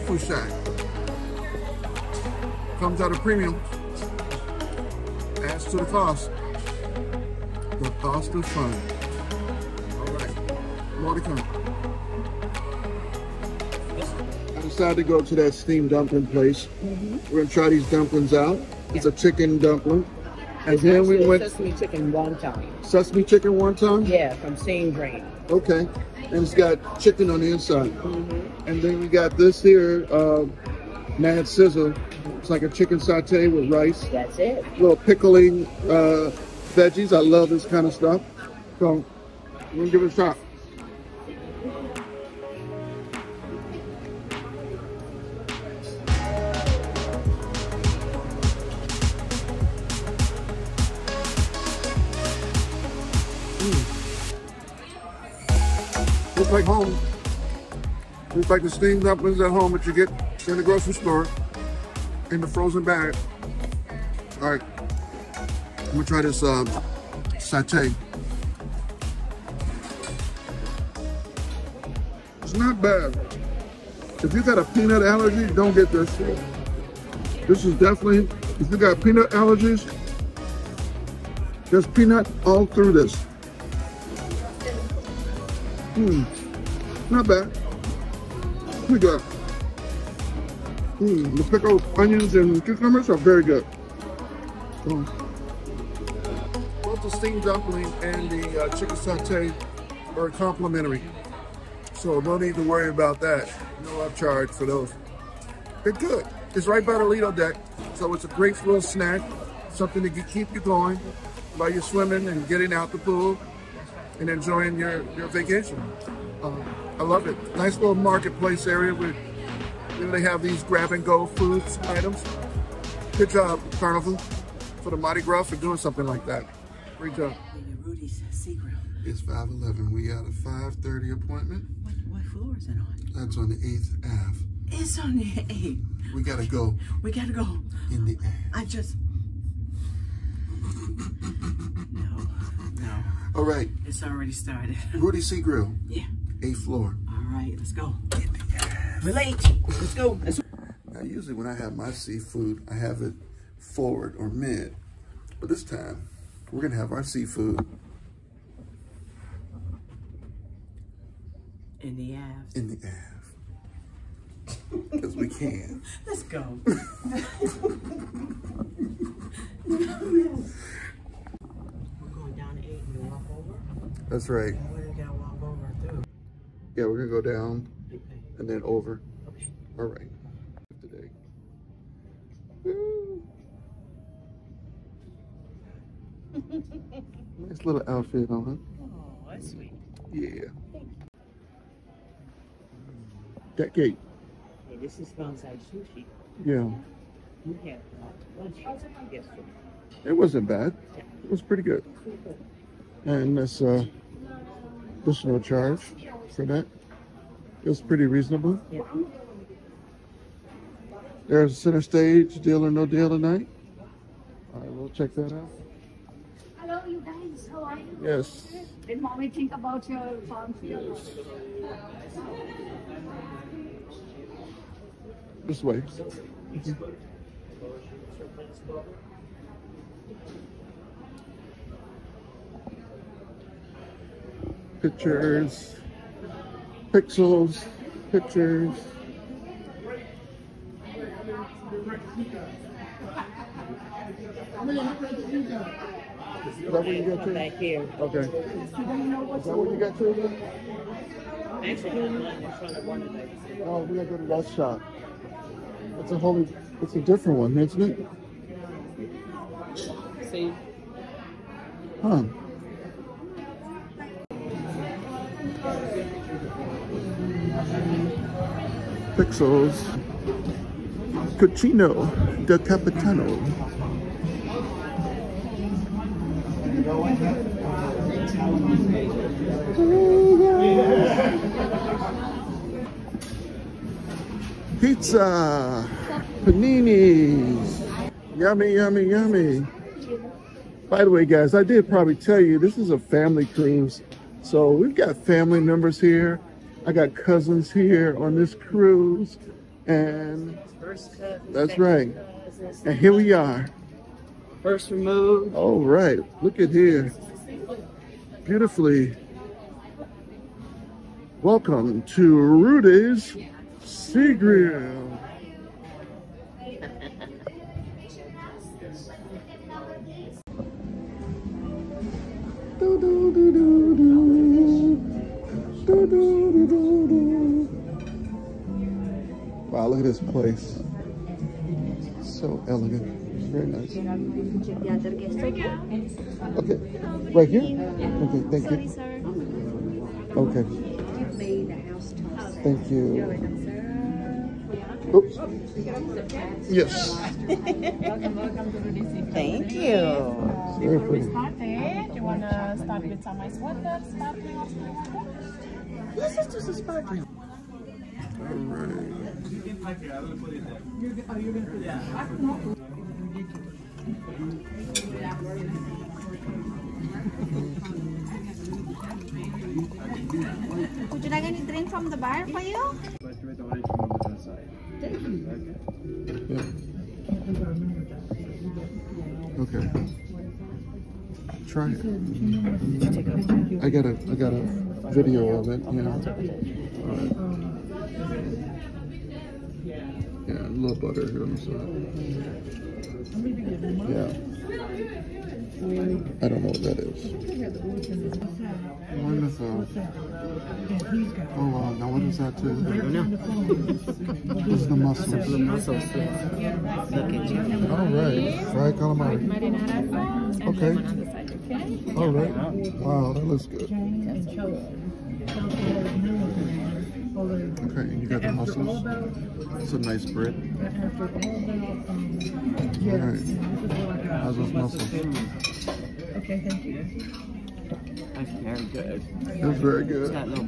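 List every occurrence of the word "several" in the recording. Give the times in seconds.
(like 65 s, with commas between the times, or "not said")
not said.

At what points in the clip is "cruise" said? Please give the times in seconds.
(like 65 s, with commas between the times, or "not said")
293 s, 298 s.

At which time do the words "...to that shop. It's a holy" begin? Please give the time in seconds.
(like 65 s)
254 s.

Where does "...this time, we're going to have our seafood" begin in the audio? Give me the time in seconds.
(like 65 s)
155 s.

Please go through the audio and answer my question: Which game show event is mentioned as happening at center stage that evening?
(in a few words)
Deal or No Deal.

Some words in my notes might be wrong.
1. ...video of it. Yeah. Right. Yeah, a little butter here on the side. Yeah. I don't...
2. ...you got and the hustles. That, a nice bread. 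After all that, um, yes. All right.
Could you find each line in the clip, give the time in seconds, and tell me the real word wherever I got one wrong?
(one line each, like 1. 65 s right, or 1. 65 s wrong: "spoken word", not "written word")
1. 385 s right
2. 418 s right.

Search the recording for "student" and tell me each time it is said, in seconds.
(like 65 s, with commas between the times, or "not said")
not said.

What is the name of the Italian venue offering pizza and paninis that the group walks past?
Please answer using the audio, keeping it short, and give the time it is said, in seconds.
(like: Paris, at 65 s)
Cucina del Capitano, at 271 s.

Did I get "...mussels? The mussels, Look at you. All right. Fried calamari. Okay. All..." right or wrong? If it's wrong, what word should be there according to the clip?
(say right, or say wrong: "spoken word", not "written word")
right.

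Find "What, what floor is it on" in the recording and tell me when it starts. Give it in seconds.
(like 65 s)
131 s.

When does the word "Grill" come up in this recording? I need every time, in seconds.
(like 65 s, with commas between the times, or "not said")
145 s, 314 s.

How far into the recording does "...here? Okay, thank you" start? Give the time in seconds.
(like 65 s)
337 s.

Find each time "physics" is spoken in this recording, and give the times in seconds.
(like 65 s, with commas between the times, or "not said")
not said.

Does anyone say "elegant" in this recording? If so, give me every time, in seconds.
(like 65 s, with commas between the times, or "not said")
332 s.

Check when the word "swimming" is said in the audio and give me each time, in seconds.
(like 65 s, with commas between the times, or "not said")
111 s.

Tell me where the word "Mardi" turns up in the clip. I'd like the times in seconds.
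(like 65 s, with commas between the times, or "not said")
124 s.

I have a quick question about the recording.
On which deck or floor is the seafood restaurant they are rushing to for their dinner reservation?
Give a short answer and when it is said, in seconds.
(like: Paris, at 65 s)
8th floor, at 146 s.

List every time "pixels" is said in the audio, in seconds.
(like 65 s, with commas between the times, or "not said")
236 s, 269 s.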